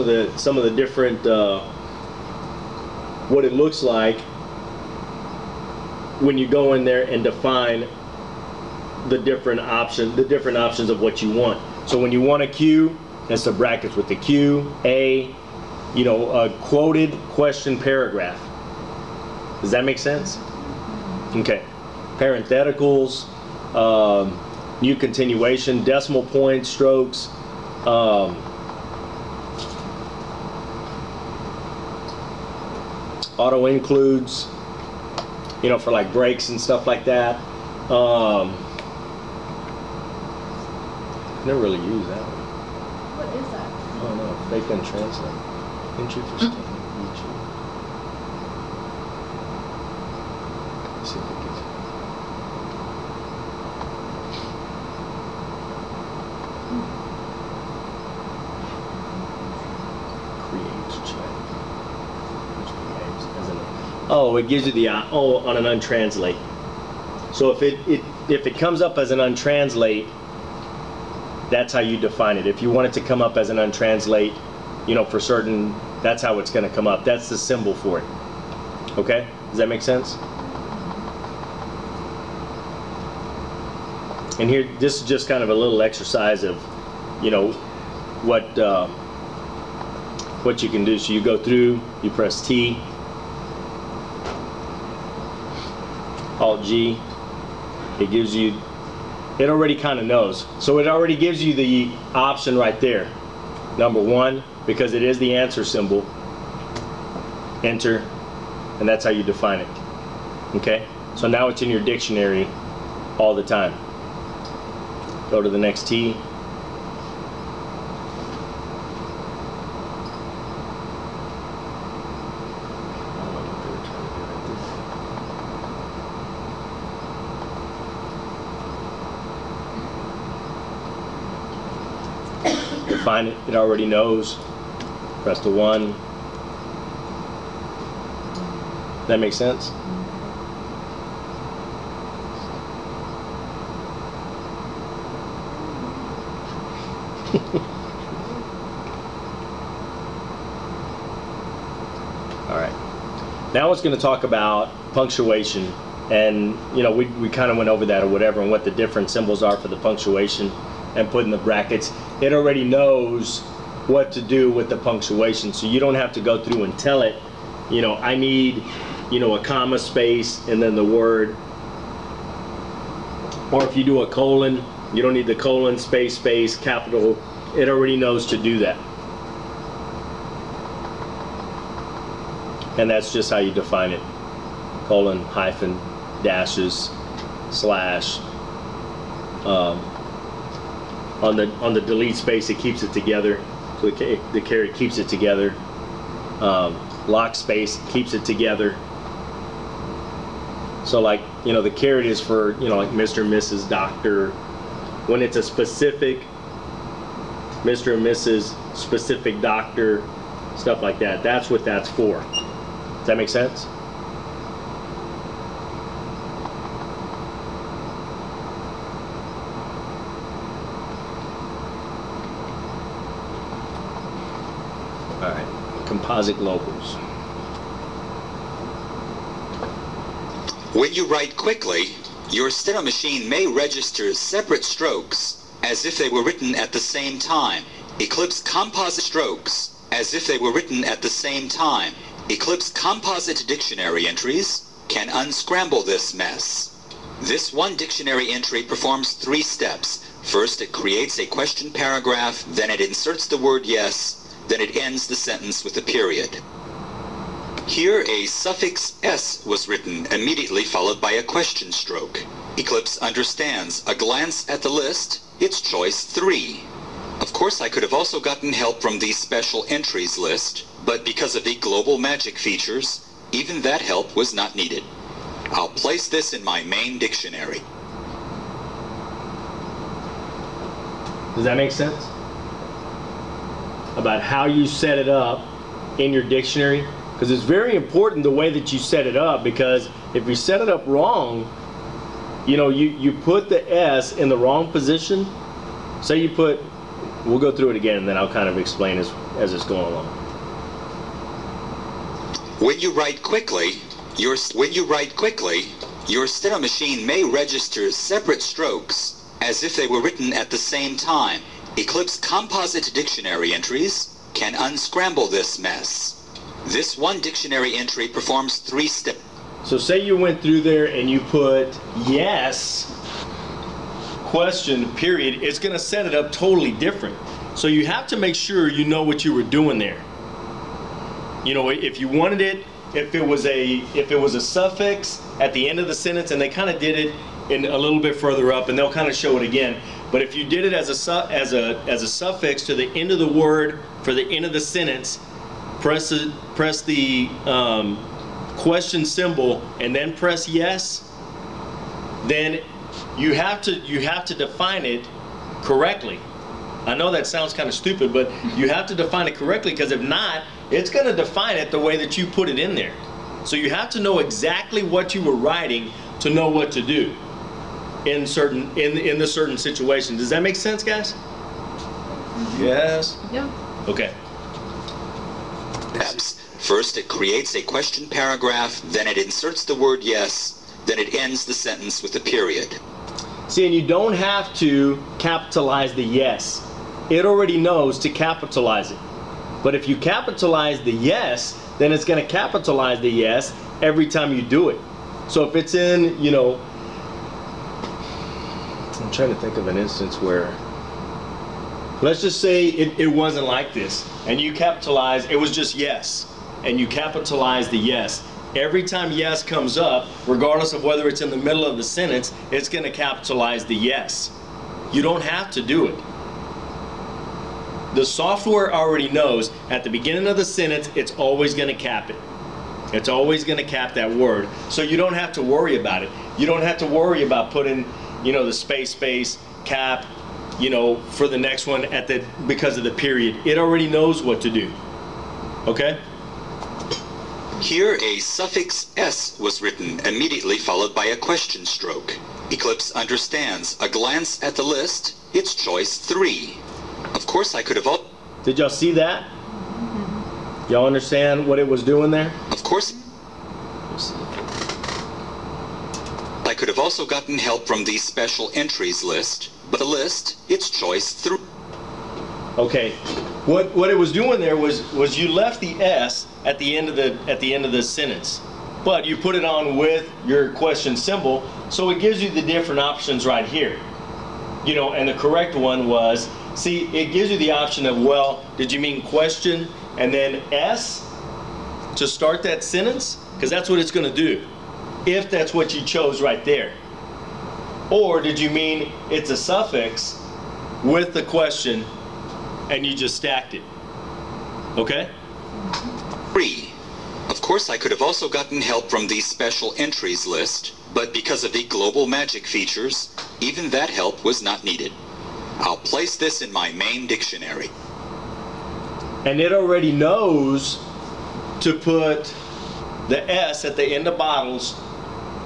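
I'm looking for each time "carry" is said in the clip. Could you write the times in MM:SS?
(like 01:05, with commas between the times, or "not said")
03:14.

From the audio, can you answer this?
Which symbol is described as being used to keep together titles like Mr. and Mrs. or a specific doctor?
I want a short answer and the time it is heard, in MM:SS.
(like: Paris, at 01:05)
caret, at 03:21.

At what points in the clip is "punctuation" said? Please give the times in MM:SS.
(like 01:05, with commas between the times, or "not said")
02:34, 02:39, 02:44.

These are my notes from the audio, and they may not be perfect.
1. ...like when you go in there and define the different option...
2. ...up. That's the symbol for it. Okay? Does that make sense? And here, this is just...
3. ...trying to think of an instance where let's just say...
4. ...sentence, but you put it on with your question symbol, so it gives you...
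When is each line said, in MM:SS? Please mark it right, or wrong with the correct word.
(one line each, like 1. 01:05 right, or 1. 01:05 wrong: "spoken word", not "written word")
1. 00:03 right
2. 01:16 right
3. 06:39 right
4. 07:47 right.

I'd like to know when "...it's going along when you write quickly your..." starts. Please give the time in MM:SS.
04:59.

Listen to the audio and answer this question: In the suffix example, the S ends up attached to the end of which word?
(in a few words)
bottles.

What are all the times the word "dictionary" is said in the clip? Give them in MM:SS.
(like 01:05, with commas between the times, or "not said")
01:51, 04:03, 04:07, 04:36, 04:46, 05:12, 05:17, 08:27.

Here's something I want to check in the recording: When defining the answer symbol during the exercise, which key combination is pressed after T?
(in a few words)
Alt G.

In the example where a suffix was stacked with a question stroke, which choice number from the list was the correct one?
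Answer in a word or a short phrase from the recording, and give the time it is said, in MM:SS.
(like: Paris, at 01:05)
3, at 04:25.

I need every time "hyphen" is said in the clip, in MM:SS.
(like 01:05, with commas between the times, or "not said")
03:05.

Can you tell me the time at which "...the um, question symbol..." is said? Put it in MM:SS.
05:46.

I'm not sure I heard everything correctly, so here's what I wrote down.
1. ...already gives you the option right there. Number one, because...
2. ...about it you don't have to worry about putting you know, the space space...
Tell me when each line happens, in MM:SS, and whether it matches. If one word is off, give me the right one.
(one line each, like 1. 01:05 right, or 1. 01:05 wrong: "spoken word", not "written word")
1. 01:40 right
2. 07:05 right.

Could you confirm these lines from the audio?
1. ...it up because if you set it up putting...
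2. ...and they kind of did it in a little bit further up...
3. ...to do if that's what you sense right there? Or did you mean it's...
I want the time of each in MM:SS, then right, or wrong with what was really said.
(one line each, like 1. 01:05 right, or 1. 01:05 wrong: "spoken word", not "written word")
1. 04:49 wrong: "wrong", not "putting"
2. 05:36 right
3. 08:04 wrong: "chose", not "sense".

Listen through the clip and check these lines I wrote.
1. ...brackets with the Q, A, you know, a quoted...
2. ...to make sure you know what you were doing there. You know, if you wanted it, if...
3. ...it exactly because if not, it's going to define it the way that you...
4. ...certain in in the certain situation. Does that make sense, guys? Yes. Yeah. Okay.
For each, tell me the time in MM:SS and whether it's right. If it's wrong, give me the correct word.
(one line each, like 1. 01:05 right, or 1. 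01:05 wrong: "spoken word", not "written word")
1. 00:13 right
2. 05:28 right
3. 05:59 wrong: "correctly", not "exactly"
4. 06:08 right.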